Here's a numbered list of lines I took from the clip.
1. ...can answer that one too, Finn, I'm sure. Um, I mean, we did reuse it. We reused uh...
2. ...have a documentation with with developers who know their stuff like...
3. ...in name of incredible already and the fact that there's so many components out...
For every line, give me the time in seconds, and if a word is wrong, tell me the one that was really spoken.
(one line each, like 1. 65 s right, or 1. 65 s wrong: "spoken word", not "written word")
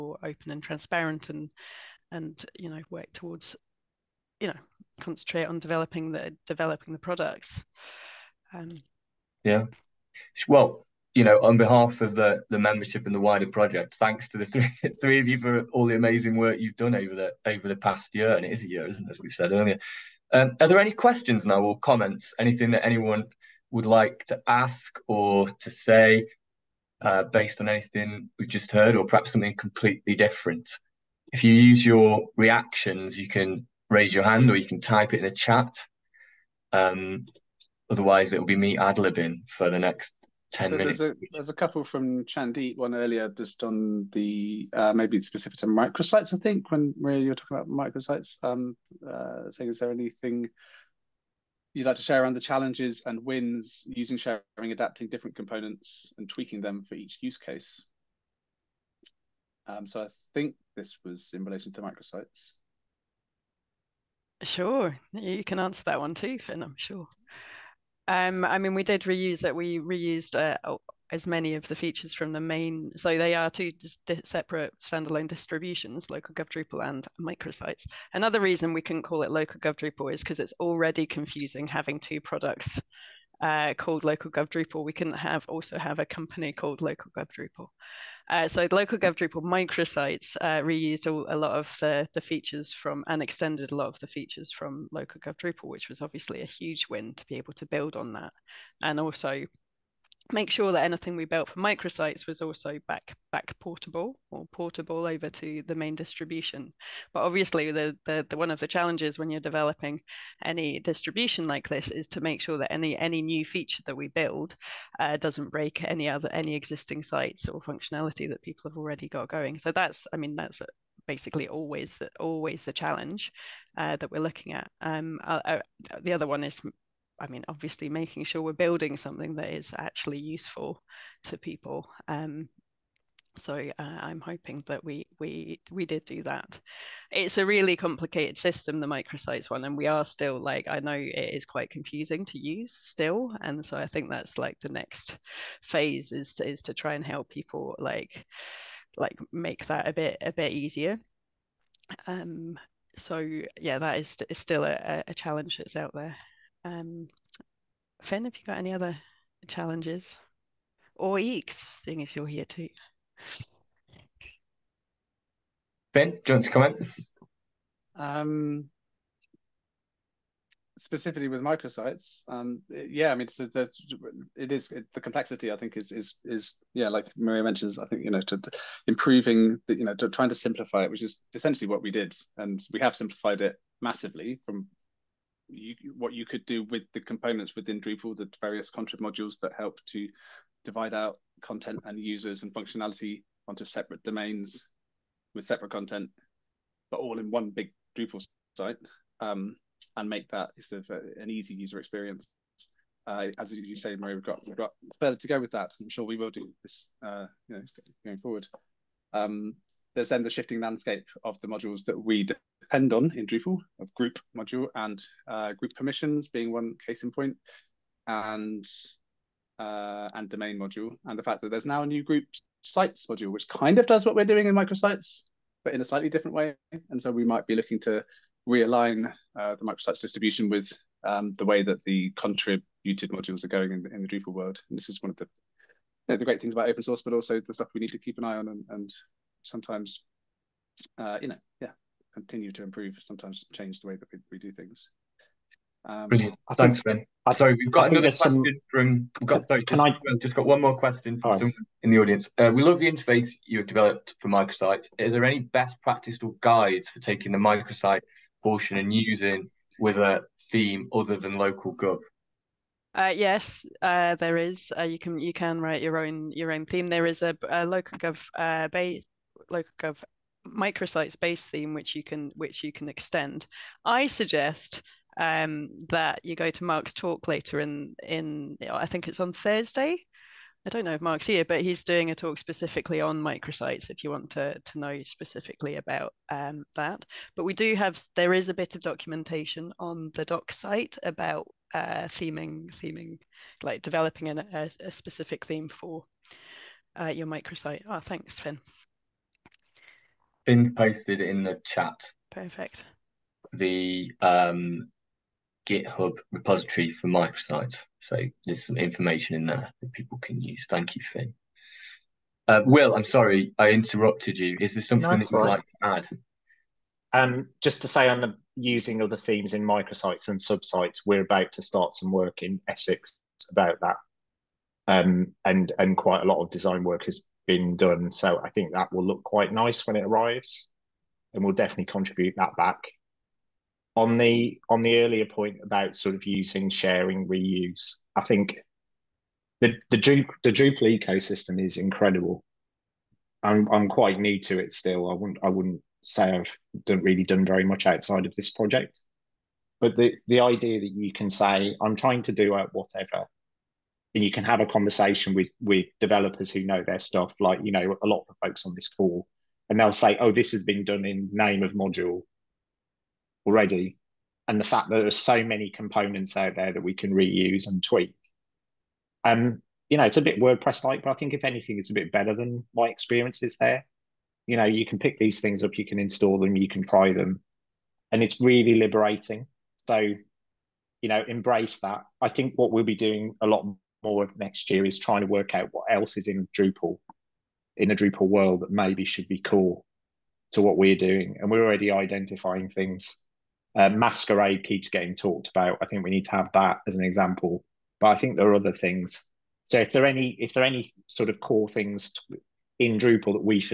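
1. 65 s right
2. 354 s wrong: "conversation", not "documentation"
3. 361 s wrong: "module", not "incredible".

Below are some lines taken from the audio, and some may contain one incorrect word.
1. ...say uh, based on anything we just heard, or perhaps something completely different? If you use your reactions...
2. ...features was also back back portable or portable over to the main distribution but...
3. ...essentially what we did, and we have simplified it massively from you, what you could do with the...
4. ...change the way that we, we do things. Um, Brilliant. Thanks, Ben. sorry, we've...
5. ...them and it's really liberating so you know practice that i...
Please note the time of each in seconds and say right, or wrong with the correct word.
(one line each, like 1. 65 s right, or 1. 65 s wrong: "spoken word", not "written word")
1. 25 s right
2. 101 s wrong: "microsites", not "features"
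3. 181 s right
4. 243 s right
5. 377 s wrong: "embrace", not "practice".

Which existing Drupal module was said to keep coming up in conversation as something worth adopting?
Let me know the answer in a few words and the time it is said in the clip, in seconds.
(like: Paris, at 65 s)
Masquerade, at 393 s.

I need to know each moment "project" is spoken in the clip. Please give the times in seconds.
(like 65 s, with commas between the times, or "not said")
13 s, 348 s.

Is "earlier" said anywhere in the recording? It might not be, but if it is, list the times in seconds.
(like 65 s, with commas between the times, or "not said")
19 s, 42 s, 335 s.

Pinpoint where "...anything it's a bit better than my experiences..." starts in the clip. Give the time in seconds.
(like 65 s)
371 s.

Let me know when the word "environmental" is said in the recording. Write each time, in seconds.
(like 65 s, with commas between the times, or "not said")
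not said.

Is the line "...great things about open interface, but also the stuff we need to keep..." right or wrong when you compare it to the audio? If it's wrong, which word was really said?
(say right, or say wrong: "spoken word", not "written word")
wrong: "source", not "interface".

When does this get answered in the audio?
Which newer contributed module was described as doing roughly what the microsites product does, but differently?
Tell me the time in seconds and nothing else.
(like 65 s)
222 s.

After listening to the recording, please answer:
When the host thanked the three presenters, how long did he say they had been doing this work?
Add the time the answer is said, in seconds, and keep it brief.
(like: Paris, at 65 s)
a year, at 18 s.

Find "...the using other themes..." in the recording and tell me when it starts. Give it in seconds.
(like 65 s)
318 s.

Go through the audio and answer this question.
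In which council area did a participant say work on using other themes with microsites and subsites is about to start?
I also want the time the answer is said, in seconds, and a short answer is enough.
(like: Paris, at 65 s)
Essex, at 322 s.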